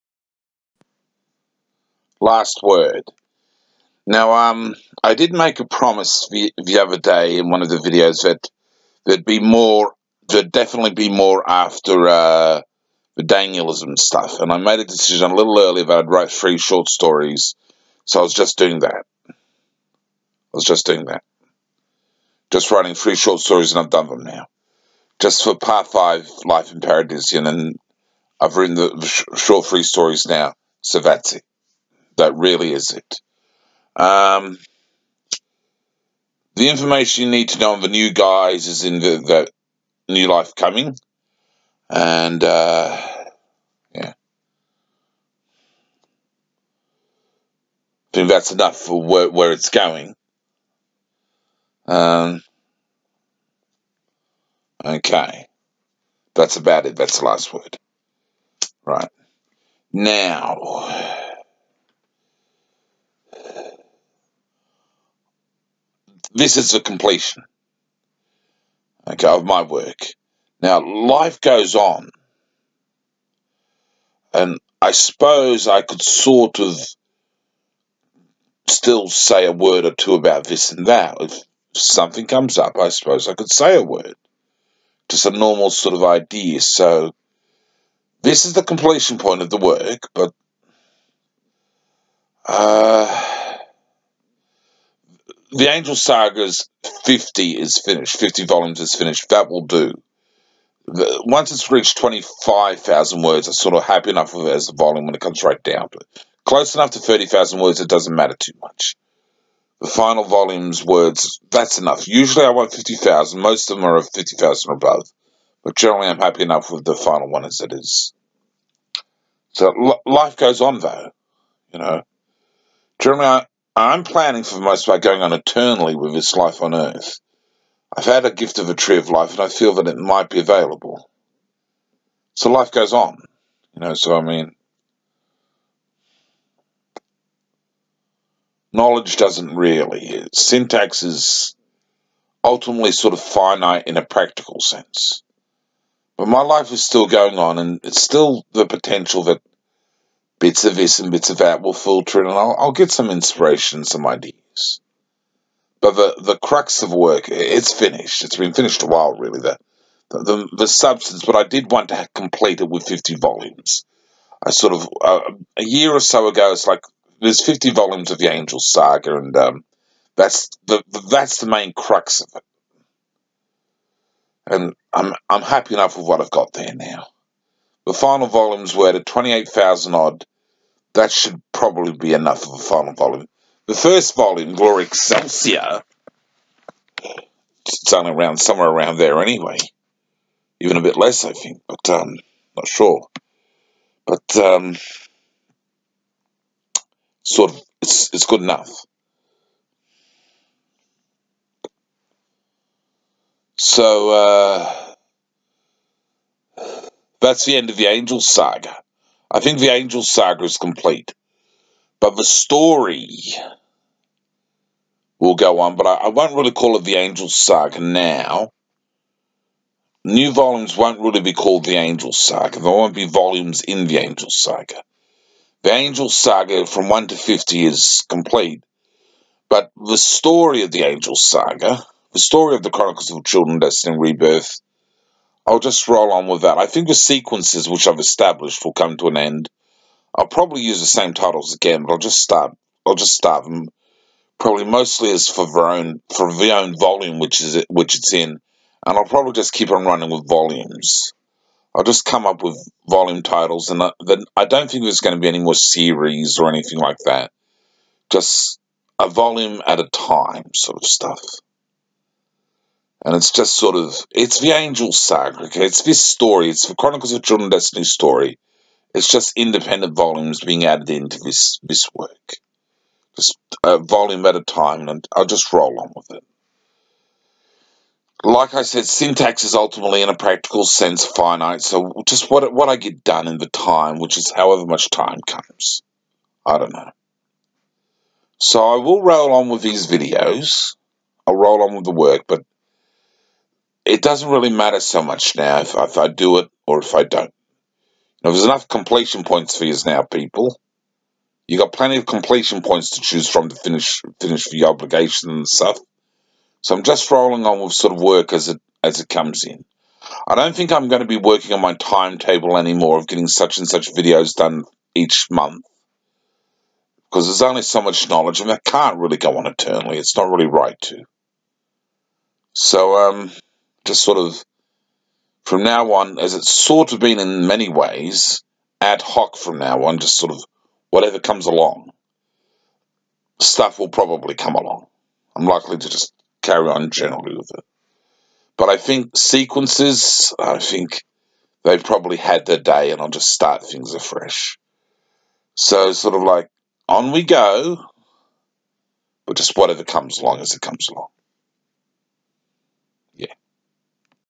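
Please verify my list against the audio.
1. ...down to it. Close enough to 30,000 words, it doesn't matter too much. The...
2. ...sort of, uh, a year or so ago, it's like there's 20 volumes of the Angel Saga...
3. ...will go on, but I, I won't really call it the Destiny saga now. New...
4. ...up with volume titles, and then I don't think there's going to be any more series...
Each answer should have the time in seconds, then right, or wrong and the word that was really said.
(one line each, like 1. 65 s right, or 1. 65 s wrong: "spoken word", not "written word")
1. 105 s right
2. 164 s wrong: "50", not "20"
3. 215 s wrong: "Angel", not "Destiny"
4. 252 s right.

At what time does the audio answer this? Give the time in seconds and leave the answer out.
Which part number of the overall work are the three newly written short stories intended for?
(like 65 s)
25 s.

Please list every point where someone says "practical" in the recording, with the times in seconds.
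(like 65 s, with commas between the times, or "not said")
144 s, 280 s.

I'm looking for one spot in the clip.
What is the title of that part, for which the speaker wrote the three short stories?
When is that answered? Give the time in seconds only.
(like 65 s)
26 s.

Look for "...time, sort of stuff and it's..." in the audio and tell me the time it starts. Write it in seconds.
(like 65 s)
259 s.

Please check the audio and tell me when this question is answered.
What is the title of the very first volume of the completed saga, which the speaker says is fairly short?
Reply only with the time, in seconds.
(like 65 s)
184 s.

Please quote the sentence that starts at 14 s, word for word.
And I made a decision a little earlier that I'd write three short stories.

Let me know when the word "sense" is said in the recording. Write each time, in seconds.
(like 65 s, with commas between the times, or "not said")
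144 s, 280 s.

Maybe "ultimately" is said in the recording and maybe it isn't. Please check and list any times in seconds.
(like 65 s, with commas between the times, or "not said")
142 s, 279 s.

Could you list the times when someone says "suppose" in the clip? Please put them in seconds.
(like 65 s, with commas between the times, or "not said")
74 s, 82 s.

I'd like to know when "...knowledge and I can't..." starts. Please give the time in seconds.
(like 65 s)
318 s.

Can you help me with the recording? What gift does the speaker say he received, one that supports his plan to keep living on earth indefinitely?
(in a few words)
a tree of life.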